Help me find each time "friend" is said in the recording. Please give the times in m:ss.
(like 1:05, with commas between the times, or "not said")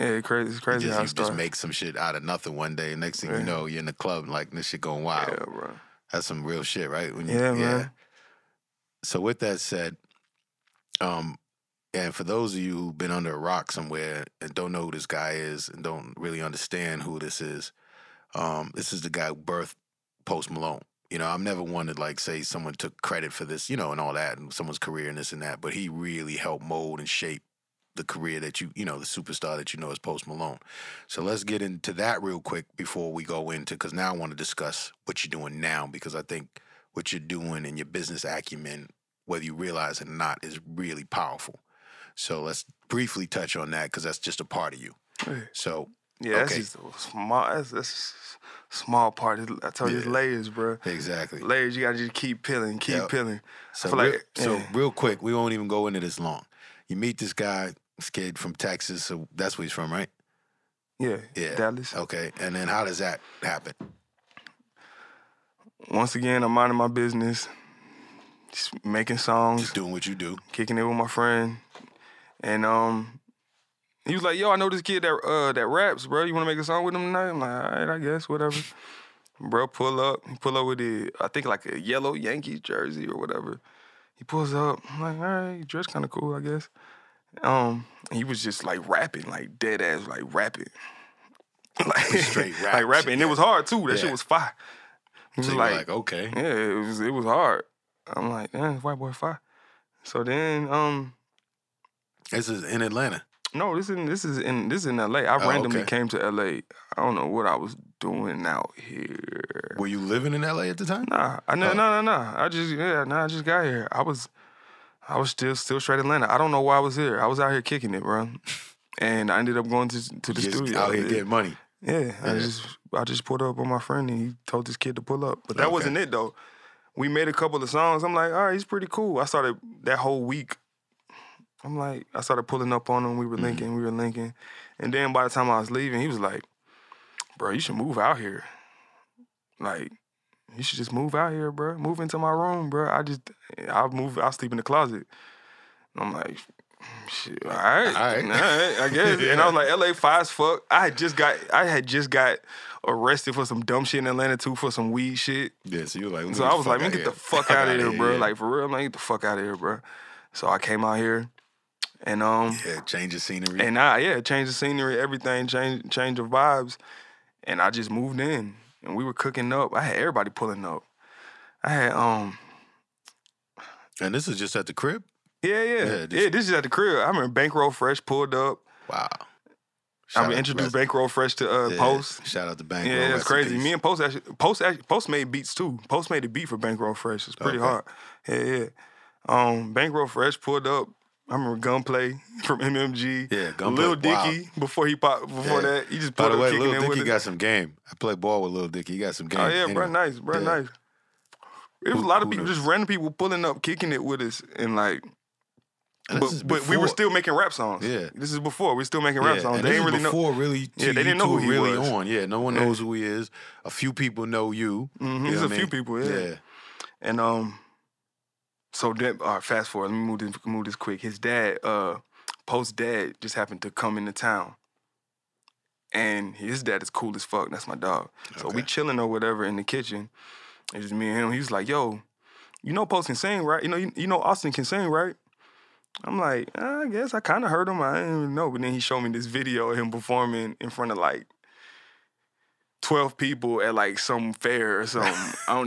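1:11, 2:03.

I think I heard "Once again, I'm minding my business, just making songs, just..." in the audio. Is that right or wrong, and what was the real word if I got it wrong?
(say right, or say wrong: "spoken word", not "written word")
right.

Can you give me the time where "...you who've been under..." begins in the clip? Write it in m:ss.
0:12.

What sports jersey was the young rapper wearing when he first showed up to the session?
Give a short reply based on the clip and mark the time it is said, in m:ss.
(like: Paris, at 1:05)
Yellow Yankees jersey, at 1:21.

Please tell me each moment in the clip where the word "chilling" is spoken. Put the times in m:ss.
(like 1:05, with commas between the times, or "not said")
3:48.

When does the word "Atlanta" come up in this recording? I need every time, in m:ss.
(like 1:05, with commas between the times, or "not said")
1:42, 1:55, 2:34.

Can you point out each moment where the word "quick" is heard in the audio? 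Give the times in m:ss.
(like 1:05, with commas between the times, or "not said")
0:32, 0:54, 3:40.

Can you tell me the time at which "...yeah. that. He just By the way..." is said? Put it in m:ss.
3:15.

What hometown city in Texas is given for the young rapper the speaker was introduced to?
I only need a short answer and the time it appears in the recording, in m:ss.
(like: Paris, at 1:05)
Dallas, at 1:01.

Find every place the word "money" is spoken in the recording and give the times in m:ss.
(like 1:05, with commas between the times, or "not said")
2:01.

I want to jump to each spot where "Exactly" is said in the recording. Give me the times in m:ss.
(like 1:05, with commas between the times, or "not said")
0:50.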